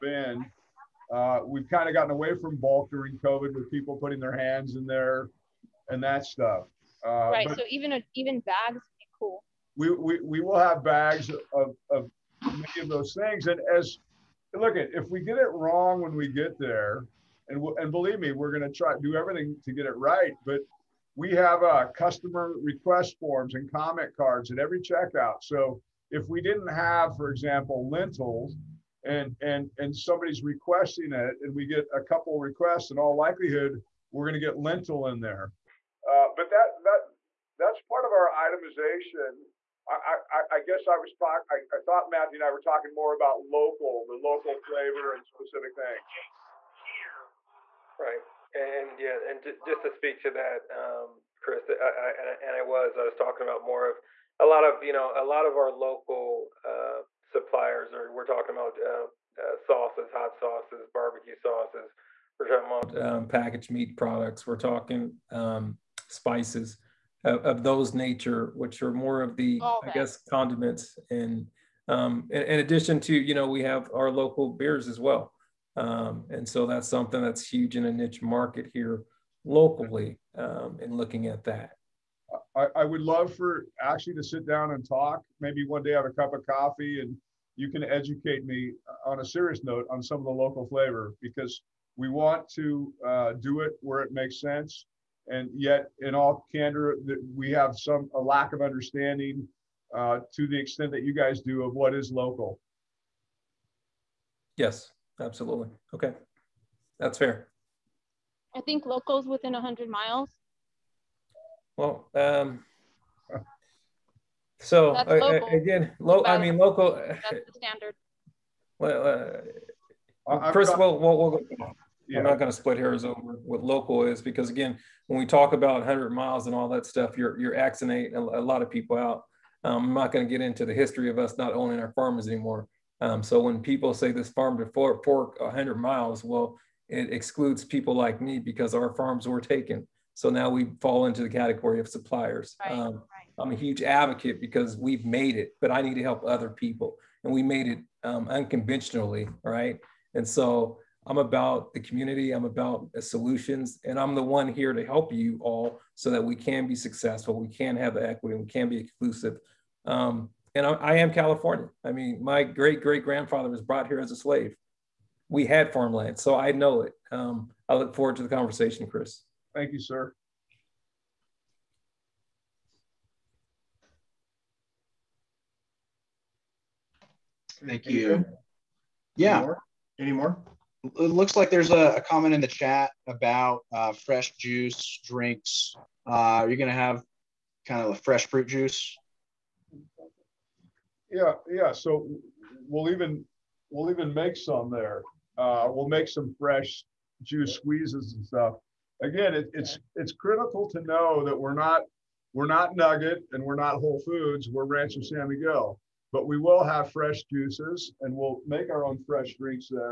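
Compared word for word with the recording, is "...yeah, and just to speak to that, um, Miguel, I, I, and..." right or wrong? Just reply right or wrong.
wrong.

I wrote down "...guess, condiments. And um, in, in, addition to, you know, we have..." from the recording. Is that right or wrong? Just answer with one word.
right.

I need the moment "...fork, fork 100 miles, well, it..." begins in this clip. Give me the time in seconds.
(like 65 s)
134 s.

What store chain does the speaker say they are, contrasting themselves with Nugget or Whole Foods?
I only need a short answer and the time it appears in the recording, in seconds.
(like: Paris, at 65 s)
Rancho San Miguel, at 204 s.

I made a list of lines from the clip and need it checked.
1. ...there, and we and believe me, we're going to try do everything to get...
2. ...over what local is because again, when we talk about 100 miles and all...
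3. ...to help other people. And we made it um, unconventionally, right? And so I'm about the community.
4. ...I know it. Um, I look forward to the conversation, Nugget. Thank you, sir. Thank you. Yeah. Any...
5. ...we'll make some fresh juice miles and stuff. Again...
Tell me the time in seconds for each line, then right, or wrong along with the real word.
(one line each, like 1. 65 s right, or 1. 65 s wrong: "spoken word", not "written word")
1. 16 s right
2. 123 s right
3. 145 s right
4. 166 s wrong: "Chris", not "Nugget"
5. 195 s wrong: "squeezes", not "miles".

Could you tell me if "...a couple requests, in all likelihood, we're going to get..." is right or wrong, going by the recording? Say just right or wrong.
right.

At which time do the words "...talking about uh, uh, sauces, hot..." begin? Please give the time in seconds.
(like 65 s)
58 s.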